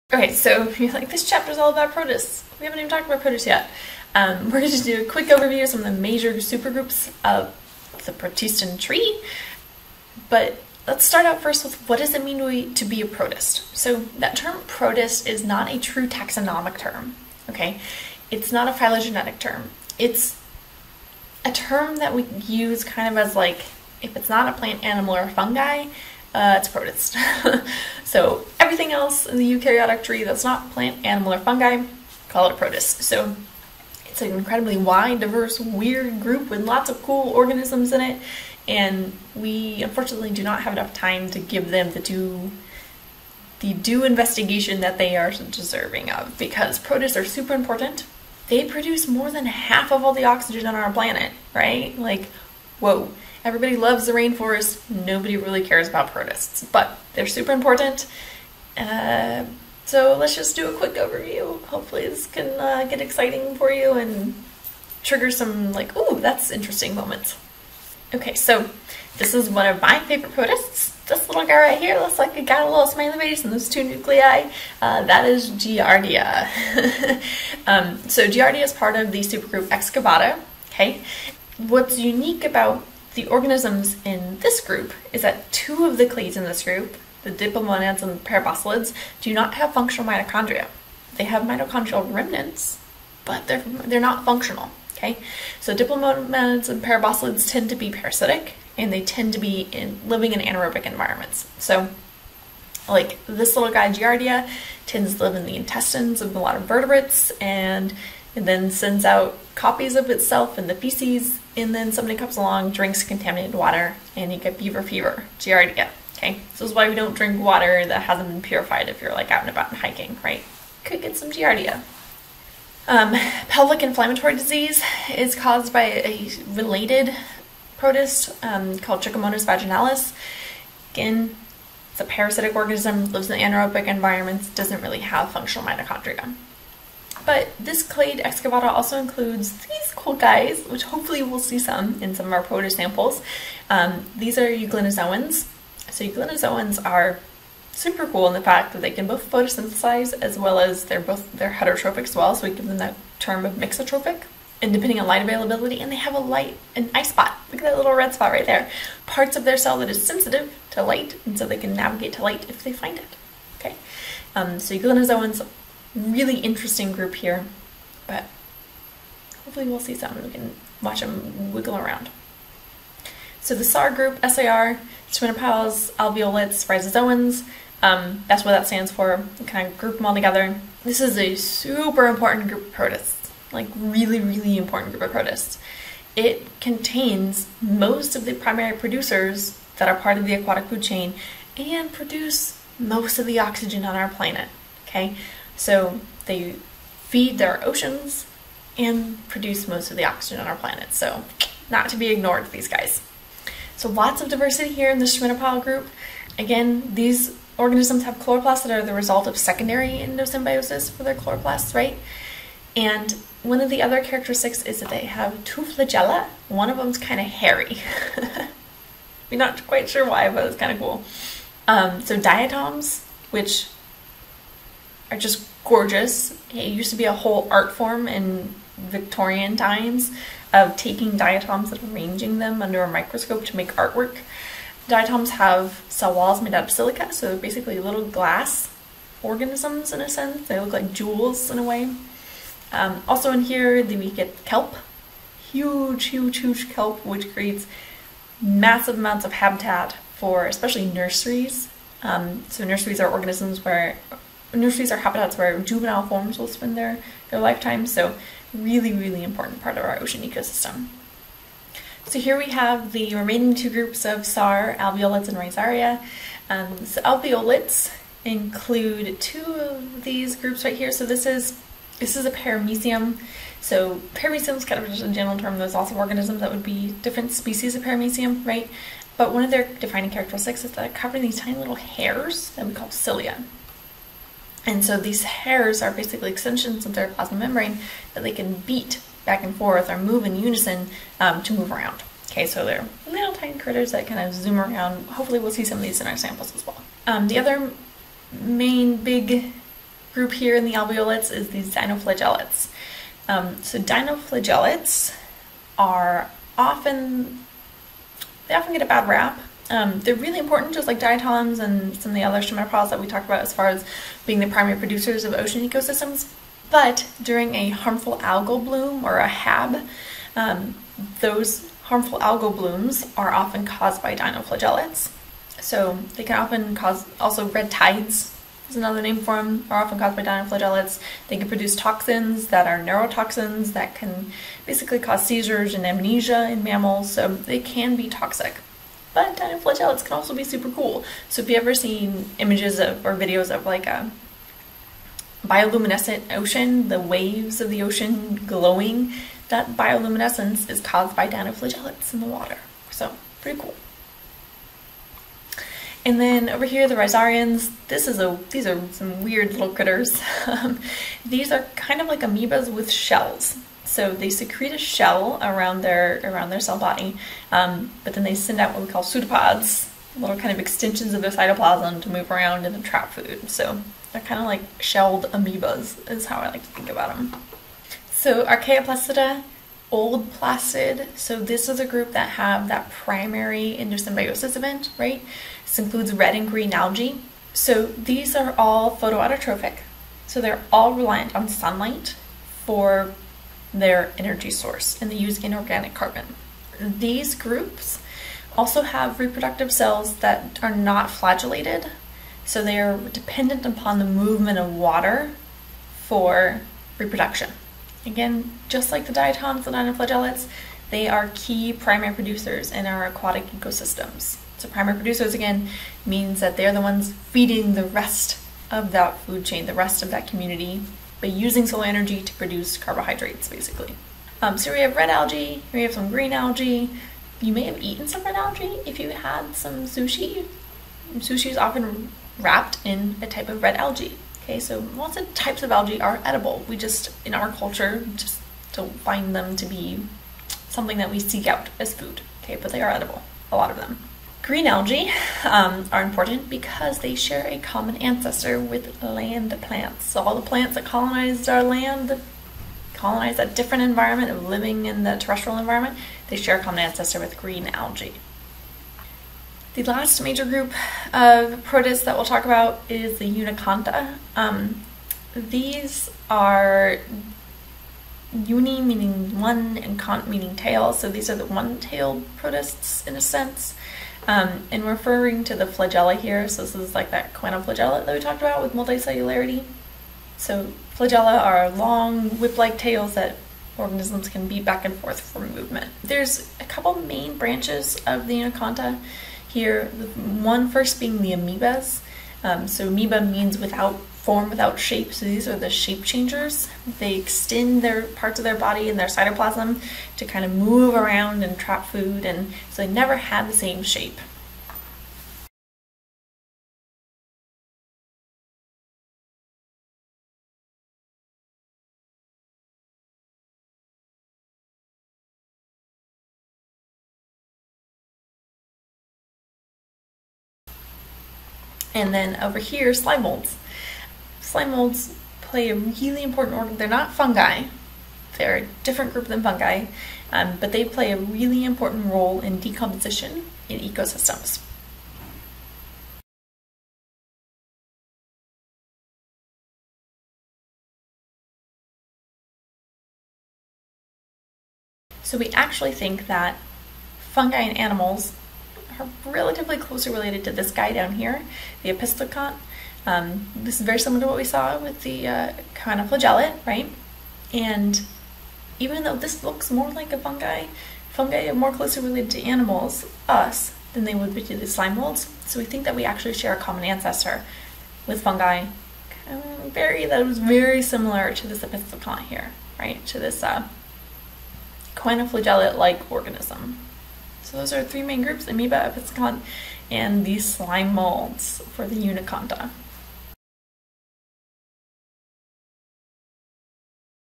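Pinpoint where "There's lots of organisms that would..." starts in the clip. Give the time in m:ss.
4:35.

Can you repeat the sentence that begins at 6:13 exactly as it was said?
So they're kind of like shelled amoebas is how I like to think about them.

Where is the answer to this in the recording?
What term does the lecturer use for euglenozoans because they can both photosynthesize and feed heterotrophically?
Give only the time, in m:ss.
2:33.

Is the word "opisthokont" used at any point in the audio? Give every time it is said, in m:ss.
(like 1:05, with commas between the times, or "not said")
9:11, 9:31, 9:38.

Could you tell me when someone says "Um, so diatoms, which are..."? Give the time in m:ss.
3:41.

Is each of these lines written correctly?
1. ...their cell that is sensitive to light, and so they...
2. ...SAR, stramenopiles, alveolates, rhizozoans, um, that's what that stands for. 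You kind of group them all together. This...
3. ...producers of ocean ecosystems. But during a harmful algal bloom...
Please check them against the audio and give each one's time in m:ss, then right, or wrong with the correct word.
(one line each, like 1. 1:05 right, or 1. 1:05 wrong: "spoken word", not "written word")
1. 2:39 right
2. 2:54 right
3. 5:14 right.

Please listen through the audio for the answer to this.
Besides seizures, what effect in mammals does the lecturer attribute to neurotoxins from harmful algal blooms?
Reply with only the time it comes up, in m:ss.
5:35.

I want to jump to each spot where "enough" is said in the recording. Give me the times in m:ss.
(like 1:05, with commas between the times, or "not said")
0:40.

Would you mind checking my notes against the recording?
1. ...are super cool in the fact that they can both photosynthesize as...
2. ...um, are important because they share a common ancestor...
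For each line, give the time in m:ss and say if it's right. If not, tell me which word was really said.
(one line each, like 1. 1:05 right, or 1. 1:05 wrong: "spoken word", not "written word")
1. 2:26 right
2. 7:25 right.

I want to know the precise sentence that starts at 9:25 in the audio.
So we think that we actually share a common ancestor with fungi.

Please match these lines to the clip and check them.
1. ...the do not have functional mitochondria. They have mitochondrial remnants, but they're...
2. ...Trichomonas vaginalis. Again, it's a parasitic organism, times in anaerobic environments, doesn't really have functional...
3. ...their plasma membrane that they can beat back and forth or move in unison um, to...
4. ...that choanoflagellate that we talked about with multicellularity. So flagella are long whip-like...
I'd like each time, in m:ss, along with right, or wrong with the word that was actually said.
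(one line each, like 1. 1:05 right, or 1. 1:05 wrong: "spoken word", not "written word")
1. 1:28 right
2. 2:09 wrong: "lives", not "times"
3. 4:46 right
4. 7:57 right.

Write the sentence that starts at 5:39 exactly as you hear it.
But dinoflagellates can also be super cool.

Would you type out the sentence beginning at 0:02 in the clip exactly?
We haven't even talked about protists yet.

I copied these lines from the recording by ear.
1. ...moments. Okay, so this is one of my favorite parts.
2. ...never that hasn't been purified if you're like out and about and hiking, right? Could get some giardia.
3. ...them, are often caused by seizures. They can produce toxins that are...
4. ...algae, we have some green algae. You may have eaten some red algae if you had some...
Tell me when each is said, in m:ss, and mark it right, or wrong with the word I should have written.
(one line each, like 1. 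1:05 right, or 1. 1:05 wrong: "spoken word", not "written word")
1. 1:06 wrong: "protists", not "parts"
2. 1:57 wrong: "water", not "never"
3. 5:29 wrong: "dinoflagellates", not "seizures"
4. 7:05 right.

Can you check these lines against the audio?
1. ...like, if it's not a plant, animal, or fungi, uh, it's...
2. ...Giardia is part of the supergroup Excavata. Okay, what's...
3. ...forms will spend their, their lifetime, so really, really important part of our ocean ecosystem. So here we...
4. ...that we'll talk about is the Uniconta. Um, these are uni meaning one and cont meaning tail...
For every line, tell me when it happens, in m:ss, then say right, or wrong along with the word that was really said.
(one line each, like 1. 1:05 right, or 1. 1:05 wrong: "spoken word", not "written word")
1. 0:23 right
2. 1:18 right
3. 4:16 right
4. 7:42 right.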